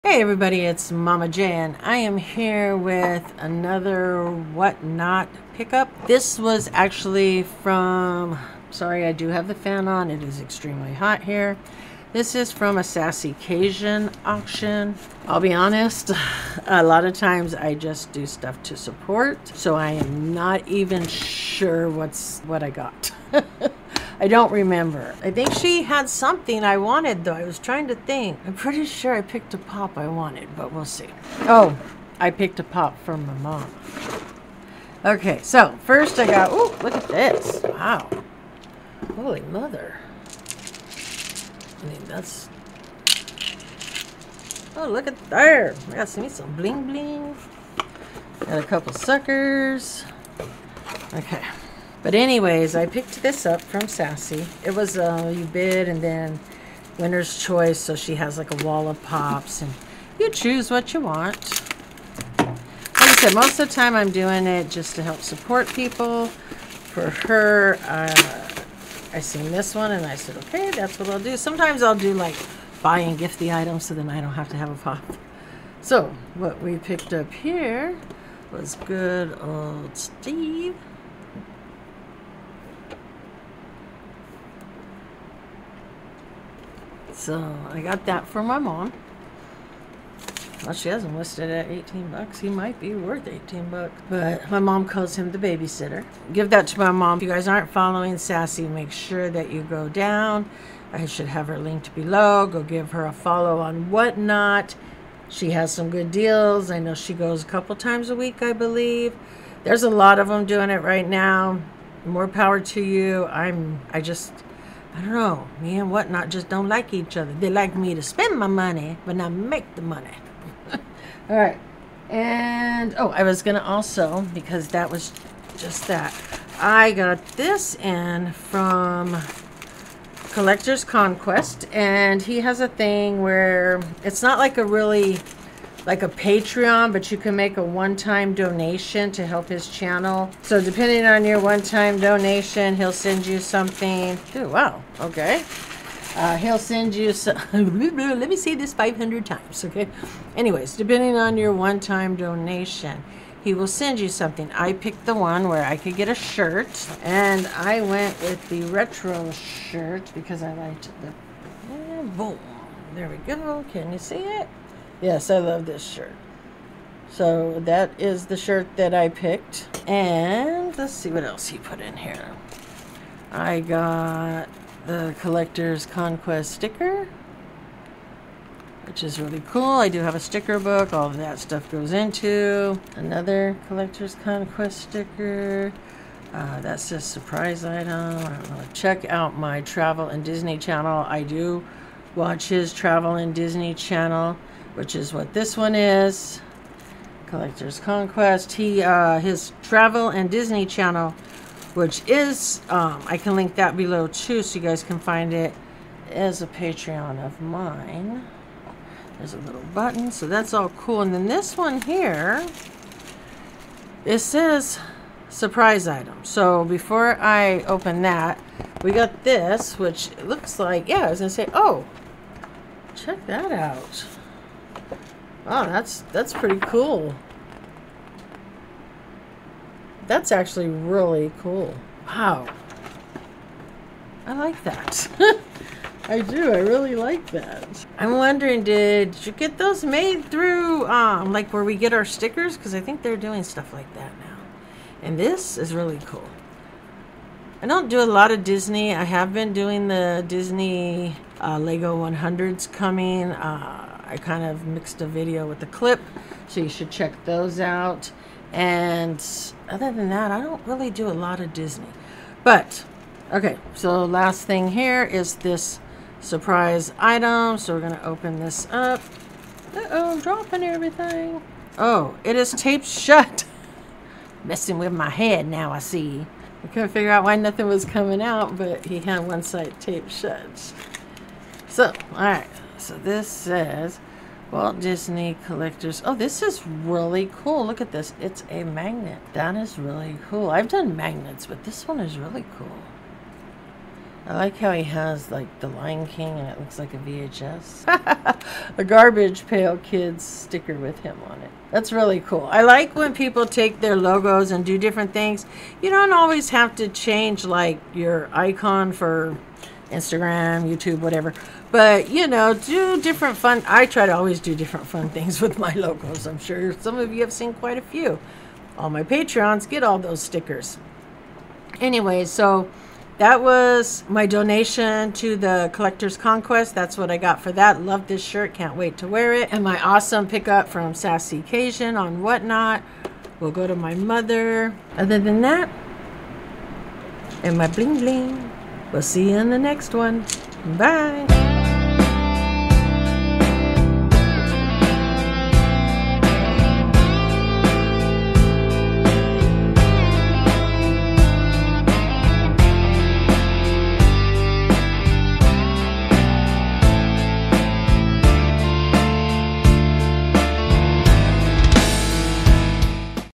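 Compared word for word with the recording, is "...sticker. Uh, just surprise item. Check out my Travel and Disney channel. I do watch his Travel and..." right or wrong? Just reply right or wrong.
right.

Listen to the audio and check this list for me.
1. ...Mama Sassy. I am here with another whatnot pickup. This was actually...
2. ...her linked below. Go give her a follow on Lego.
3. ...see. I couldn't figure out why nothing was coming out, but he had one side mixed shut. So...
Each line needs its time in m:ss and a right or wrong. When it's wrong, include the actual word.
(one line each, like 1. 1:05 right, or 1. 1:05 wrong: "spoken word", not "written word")
1. 0:00 wrong: "Jan", not "Sassy"
2. 1:41 wrong: "Whatnot", not "Lego"
3. 4:35 wrong: "taped", not "mixed".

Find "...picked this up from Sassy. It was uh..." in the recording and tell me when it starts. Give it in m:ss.
0:52.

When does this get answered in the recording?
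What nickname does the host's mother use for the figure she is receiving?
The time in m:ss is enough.
1:35.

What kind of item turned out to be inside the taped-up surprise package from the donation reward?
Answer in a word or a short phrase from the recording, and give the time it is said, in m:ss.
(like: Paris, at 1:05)
a magnet, at 4:48.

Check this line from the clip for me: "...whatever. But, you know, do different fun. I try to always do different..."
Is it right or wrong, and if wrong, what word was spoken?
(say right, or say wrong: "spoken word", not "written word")
right.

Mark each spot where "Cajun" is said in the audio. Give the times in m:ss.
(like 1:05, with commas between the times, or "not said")
0:13, 5:31.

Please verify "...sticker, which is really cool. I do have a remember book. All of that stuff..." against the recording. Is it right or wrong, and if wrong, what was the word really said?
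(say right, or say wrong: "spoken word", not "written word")
wrong: "sticker", not "remember".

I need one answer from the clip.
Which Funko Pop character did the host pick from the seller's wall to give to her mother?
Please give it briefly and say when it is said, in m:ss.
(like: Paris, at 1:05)
Steve, at 1:18.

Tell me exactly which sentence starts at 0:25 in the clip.
I think she had something I wanted, though.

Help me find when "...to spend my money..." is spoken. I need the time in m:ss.
1:57.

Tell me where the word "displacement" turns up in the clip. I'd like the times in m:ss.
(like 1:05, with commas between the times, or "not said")
not said.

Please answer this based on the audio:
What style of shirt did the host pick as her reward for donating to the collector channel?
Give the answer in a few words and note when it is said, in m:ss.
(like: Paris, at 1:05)
retro, at 2:38.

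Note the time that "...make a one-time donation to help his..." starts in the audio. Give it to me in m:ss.
2:17.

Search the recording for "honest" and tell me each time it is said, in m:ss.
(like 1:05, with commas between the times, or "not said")
0:15.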